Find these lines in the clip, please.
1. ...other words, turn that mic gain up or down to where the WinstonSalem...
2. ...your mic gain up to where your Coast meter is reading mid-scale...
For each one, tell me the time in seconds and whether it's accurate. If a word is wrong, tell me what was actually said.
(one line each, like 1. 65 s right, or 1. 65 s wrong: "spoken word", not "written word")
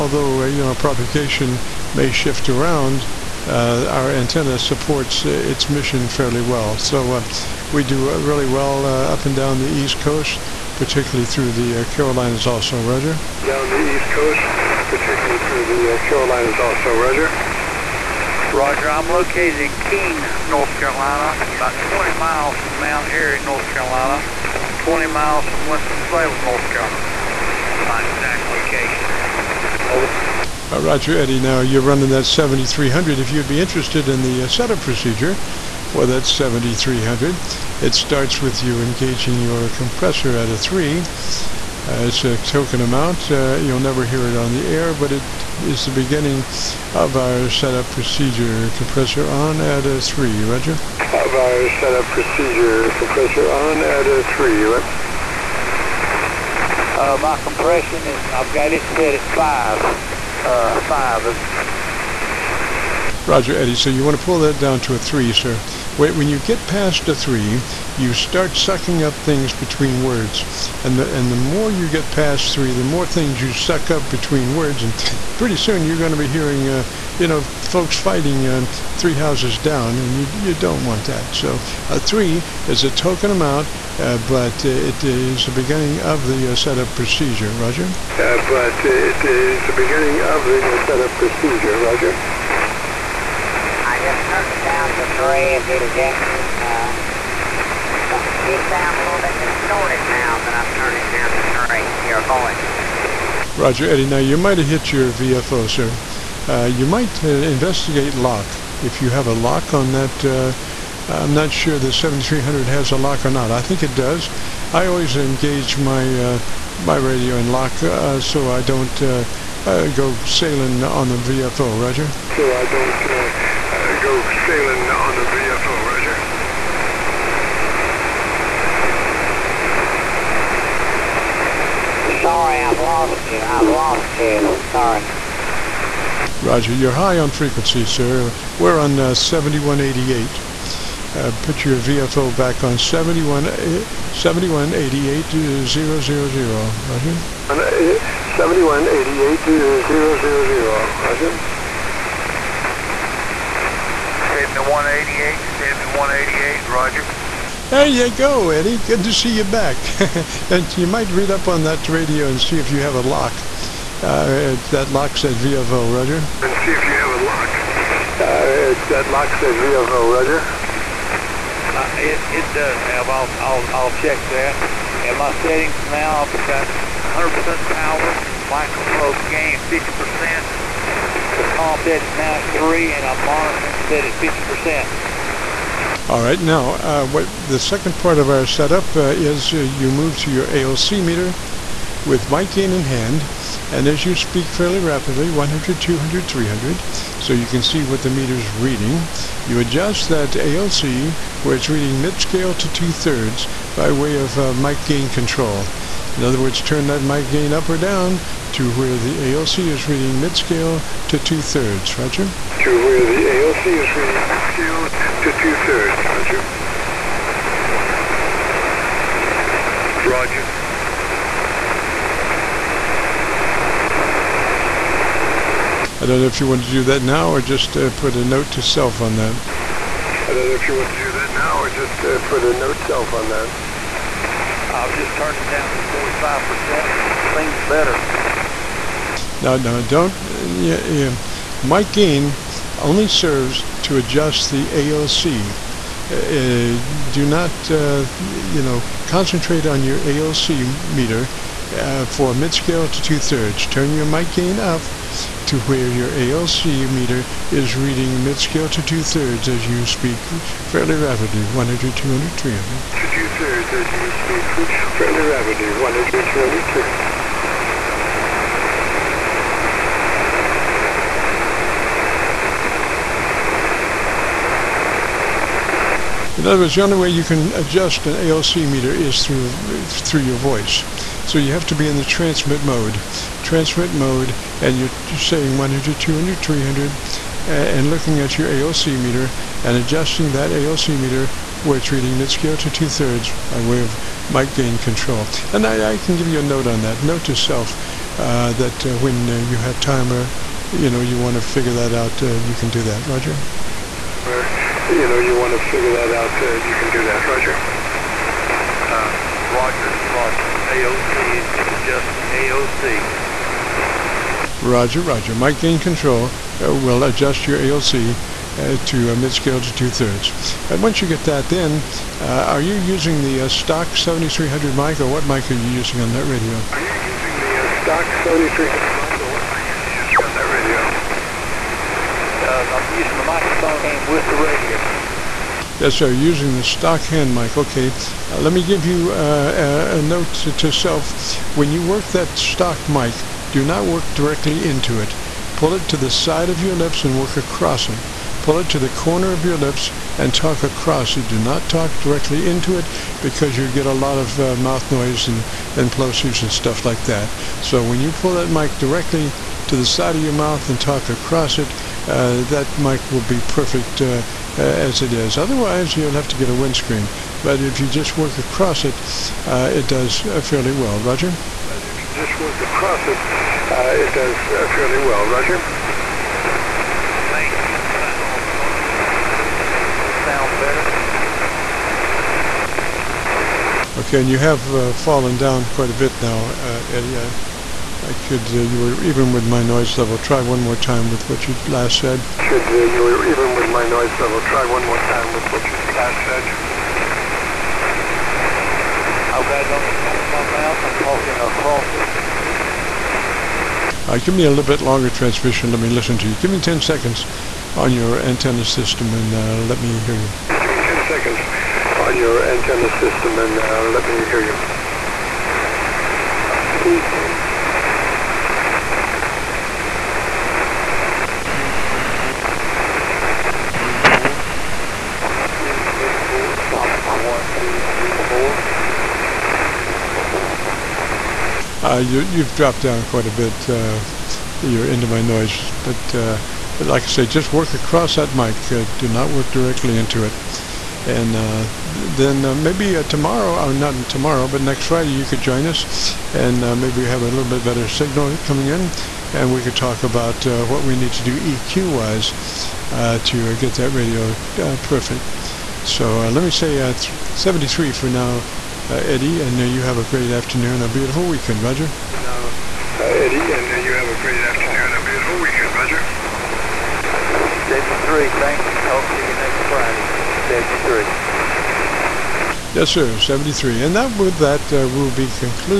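1. 206 s wrong: "ALC", not "WinstonSalem"
2. 253 s wrong: "ALC", not "Coast".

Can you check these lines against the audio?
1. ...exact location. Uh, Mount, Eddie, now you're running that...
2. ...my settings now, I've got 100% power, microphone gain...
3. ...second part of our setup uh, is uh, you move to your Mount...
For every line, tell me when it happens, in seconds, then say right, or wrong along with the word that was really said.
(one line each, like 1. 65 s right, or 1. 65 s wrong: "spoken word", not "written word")
1. 28 s wrong: "Roger", not "Mount"
2. 175 s right
3. 187 s wrong: "ALC", not "Mount".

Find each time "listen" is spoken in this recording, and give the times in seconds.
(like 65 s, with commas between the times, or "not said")
405 s.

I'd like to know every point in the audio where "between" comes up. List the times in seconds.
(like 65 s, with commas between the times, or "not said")
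69 s, 74 s.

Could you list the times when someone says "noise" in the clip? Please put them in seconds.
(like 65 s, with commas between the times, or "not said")
354 s, 389 s, 393 s, 435 s.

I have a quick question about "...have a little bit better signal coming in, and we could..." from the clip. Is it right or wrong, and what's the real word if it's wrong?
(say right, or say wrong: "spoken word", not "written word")
right.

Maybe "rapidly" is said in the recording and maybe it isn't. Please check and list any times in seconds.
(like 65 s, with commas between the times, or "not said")
194 s, 260 s.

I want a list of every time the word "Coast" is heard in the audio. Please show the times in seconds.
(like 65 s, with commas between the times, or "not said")
9 s, 14 s.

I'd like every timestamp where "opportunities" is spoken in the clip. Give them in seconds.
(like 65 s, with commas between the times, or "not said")
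not said.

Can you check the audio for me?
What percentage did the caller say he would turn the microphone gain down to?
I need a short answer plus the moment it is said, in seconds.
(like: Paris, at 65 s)
45%, at 240 s.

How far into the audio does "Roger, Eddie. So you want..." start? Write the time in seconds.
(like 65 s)
63 s.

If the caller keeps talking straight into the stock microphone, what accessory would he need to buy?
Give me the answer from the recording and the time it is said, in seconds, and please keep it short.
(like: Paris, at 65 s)
a windscreen, at 366 s.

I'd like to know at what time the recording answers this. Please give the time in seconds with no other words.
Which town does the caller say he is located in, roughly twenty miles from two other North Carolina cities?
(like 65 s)
19 s.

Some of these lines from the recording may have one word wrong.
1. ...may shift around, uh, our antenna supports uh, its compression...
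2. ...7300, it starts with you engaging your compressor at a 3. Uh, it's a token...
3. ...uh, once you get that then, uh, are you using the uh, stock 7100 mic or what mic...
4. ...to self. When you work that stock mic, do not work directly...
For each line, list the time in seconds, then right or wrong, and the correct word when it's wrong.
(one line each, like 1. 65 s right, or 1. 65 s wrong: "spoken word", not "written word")
1. 1 s wrong: "mission", not "compression"
2. 36 s right
3. 320 s wrong: "7300", not "7100"
4. 340 s right.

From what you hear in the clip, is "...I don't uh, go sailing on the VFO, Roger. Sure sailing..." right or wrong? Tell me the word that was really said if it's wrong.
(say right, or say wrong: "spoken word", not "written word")
right.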